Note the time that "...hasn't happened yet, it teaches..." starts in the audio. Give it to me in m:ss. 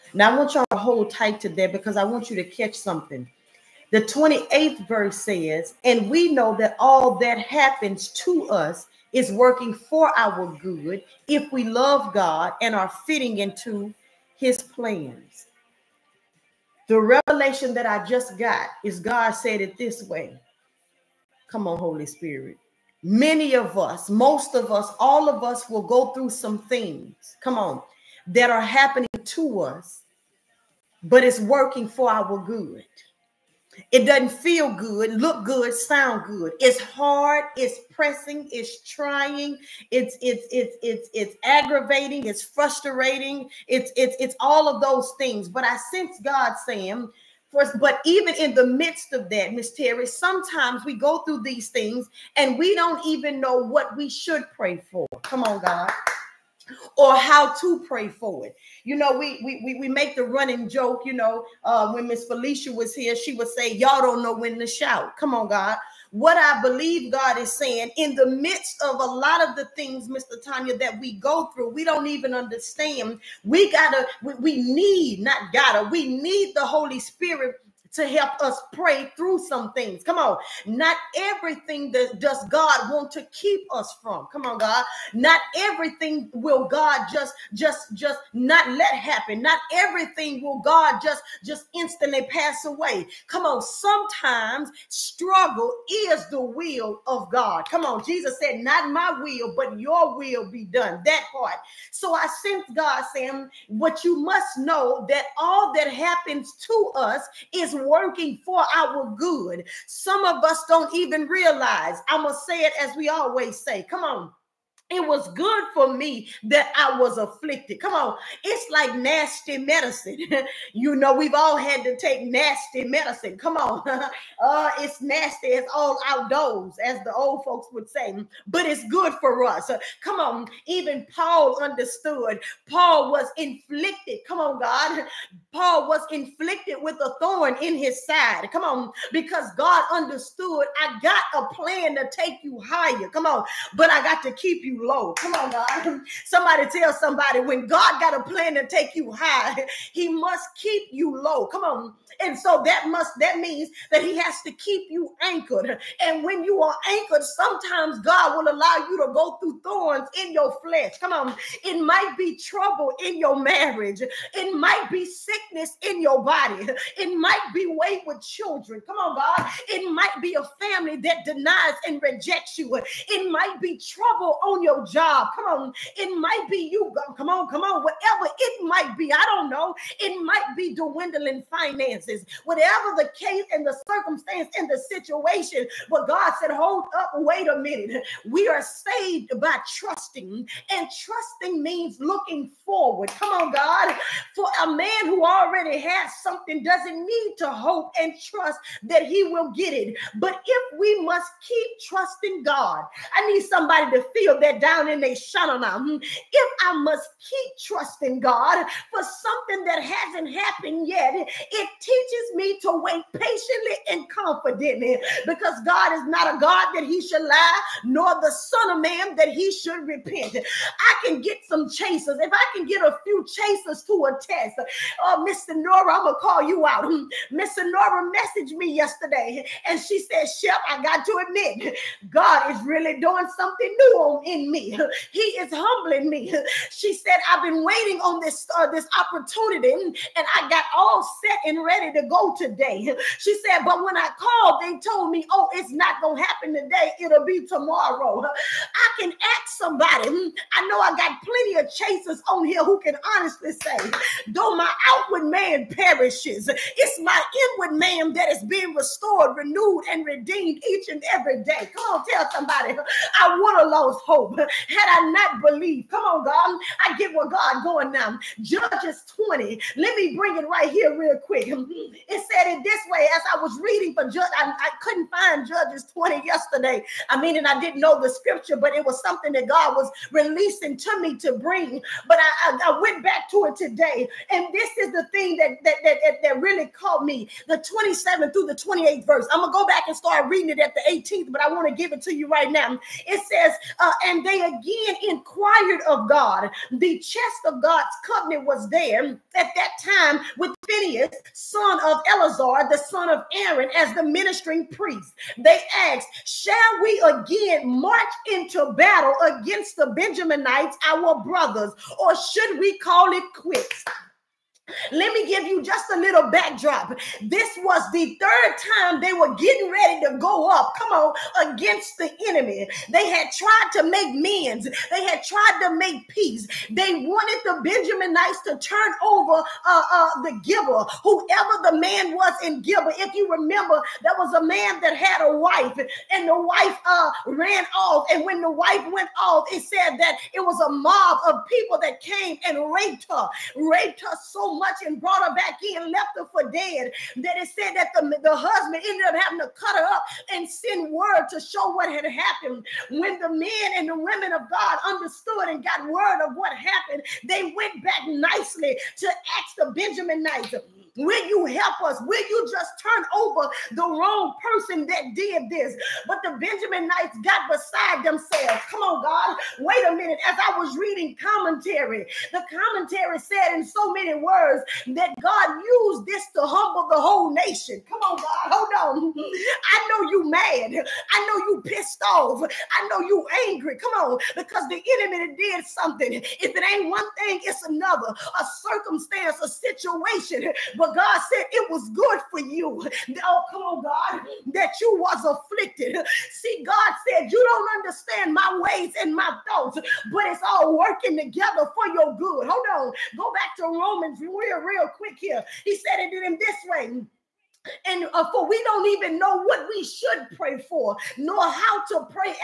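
3:29.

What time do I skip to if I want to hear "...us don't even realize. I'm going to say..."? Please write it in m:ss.
1:50.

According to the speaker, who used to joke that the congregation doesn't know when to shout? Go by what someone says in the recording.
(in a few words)
Miss Felicia.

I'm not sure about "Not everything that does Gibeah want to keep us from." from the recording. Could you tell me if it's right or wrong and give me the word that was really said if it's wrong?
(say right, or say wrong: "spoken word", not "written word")
wrong: "God", not "Gibeah".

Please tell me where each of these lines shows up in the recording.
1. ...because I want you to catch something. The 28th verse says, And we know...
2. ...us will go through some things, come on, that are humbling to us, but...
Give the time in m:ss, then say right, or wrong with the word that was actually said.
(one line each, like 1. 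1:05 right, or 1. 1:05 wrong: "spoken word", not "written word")
1. 0:01 right
2. 0:25 wrong: "happening", not "humbling".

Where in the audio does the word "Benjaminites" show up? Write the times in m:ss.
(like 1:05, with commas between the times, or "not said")
5:09, 5:27, 5:59, 6:06.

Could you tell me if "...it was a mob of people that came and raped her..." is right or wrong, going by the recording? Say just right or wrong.
right.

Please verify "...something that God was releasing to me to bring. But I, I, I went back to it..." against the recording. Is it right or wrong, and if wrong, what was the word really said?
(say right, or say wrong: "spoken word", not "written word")
right.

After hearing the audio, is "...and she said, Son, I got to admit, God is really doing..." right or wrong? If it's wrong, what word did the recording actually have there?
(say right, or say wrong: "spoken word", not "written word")
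wrong: "Shep", not "Son".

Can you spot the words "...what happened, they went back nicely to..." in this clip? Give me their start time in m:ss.
5:56.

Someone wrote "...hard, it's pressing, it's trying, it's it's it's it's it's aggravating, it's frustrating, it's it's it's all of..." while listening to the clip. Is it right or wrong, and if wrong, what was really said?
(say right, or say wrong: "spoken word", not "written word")
right.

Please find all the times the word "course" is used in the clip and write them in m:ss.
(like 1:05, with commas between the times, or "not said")
not said.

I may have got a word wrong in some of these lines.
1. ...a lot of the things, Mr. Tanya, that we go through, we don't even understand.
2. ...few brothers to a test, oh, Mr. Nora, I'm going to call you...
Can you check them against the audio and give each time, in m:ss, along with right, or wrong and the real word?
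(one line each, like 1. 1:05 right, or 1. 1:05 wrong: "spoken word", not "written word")
1. 1:09 right
2. 3:43 wrong: "chasers", not "brothers".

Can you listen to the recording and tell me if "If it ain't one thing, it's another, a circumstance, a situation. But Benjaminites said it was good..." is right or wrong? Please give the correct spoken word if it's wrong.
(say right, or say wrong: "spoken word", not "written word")
wrong: "God", not "Benjaminites".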